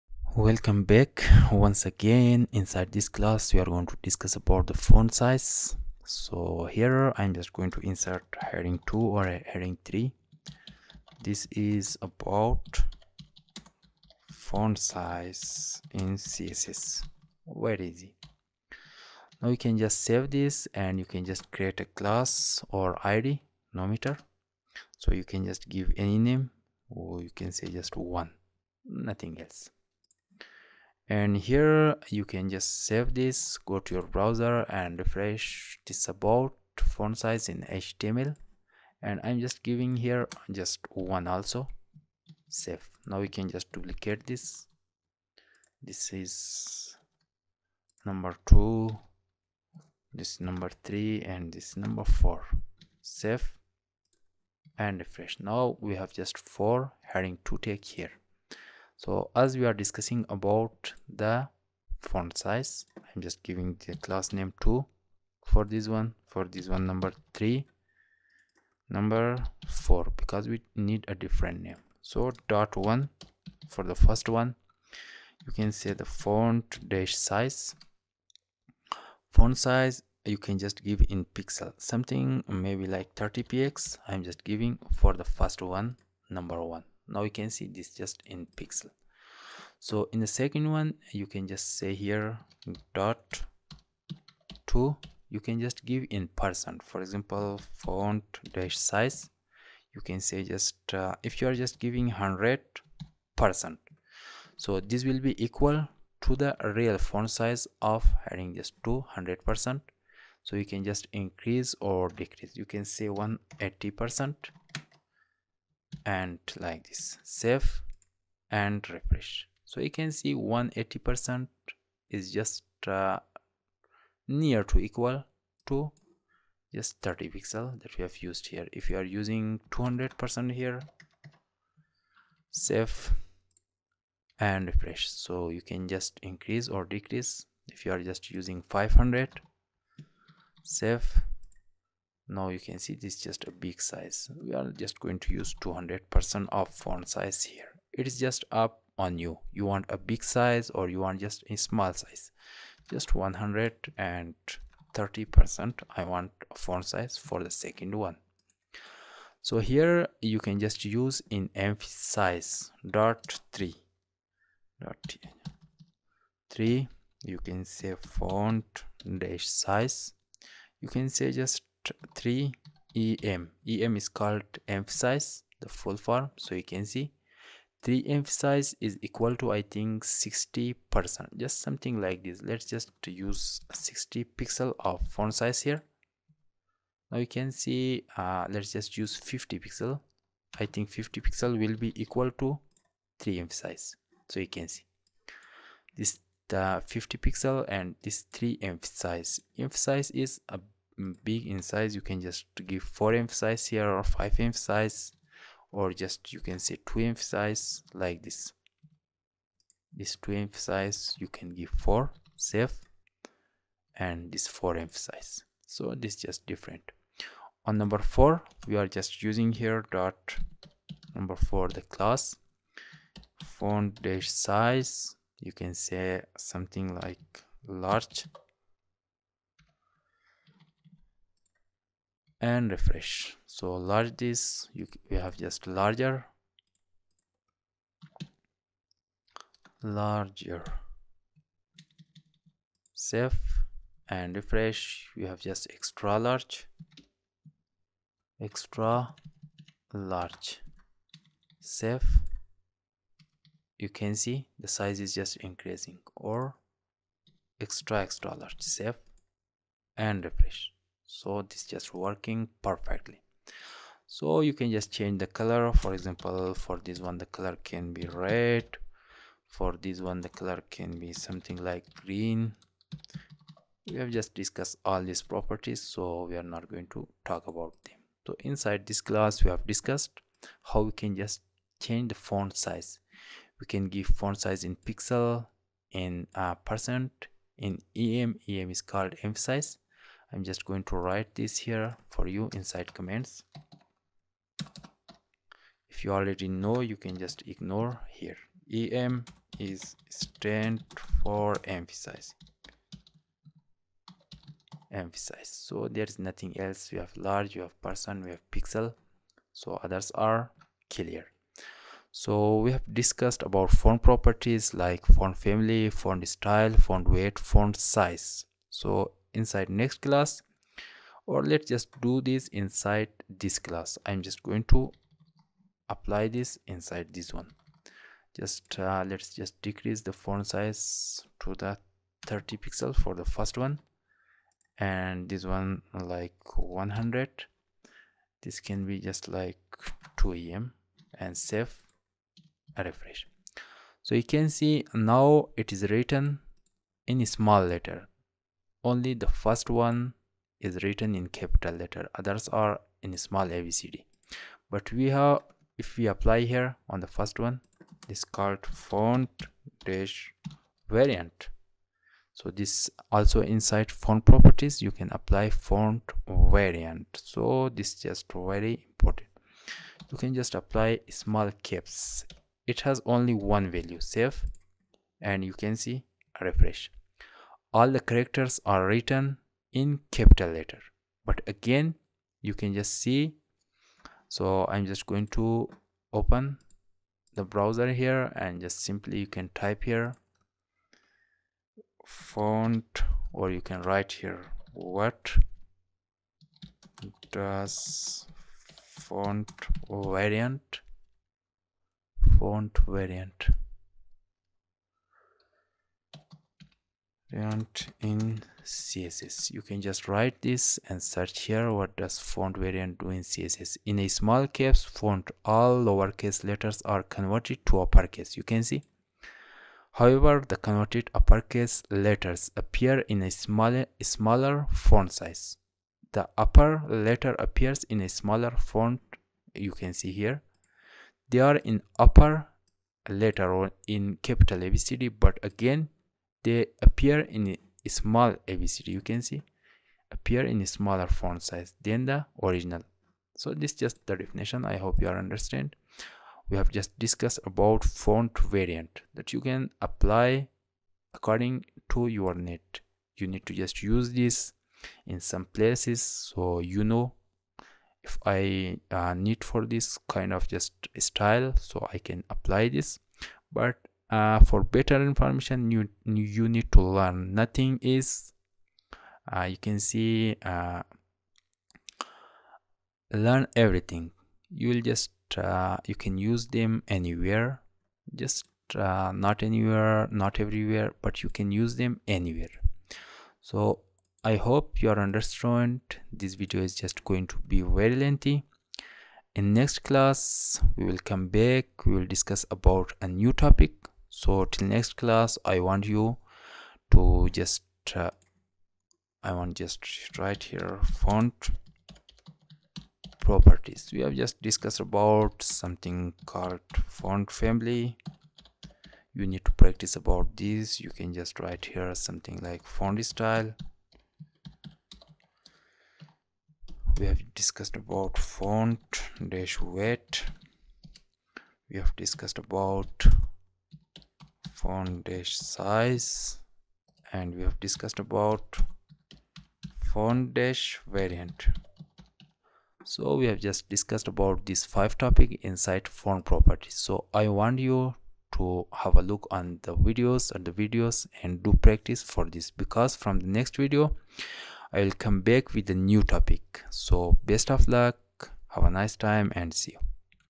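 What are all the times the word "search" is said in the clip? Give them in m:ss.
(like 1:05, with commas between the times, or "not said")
6:51.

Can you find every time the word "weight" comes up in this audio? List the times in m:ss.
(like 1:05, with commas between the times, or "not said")
5:17, 8:39.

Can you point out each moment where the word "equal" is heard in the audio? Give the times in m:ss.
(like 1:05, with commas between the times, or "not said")
1:45, 2:04, 2:59, 3:12.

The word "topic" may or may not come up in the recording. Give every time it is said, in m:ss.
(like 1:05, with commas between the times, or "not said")
8:13, 8:54, 9:06.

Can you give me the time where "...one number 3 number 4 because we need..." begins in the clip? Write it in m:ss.
1:06.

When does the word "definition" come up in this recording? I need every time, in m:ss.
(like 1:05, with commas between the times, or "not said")
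7:24.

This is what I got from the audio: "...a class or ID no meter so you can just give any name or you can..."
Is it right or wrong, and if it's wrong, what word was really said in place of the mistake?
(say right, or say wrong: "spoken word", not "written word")
right.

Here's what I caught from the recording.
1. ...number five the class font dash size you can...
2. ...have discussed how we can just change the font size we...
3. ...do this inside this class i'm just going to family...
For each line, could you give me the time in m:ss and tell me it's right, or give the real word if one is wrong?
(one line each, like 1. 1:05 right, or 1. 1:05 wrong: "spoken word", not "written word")
1. 3:41 wrong: "four", not "five"
2. 4:39 right
3. 5:22 wrong: "apply", not "family".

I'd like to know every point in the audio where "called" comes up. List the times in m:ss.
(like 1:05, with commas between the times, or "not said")
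2:54, 4:48, 5:58, 8:26.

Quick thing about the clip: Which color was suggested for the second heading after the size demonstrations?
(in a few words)
green.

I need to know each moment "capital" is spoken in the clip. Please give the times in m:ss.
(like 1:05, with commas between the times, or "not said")
5:51, 6:20, 7:14.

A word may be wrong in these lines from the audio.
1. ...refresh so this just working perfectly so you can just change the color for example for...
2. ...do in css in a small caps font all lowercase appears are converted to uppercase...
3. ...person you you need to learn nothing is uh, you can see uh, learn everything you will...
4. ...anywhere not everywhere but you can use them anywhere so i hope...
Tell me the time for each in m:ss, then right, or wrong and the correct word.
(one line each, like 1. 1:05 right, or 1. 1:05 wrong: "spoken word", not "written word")
1. 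4:20 right
2. 6:52 wrong: "letters", not "appears"
3. 7:45 wrong: "information", not "person"
4. 7:59 right.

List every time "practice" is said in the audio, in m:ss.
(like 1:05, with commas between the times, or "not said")
8:29, 9:01.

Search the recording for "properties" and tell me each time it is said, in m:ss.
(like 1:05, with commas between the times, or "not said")
4:35, 5:14, 6:04, 8:23, 8:56.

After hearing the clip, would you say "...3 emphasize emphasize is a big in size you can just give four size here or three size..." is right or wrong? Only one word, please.
wrong.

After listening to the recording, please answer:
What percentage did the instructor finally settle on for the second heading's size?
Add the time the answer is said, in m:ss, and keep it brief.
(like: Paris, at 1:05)
130 percent, at 2:33.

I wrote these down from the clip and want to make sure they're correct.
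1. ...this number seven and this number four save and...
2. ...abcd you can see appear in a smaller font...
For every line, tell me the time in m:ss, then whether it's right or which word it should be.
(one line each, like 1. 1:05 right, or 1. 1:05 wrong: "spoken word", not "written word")
1. 0:50 wrong: "three", not "seven"
2. 7:18 right.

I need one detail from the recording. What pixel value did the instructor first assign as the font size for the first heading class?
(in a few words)
30px.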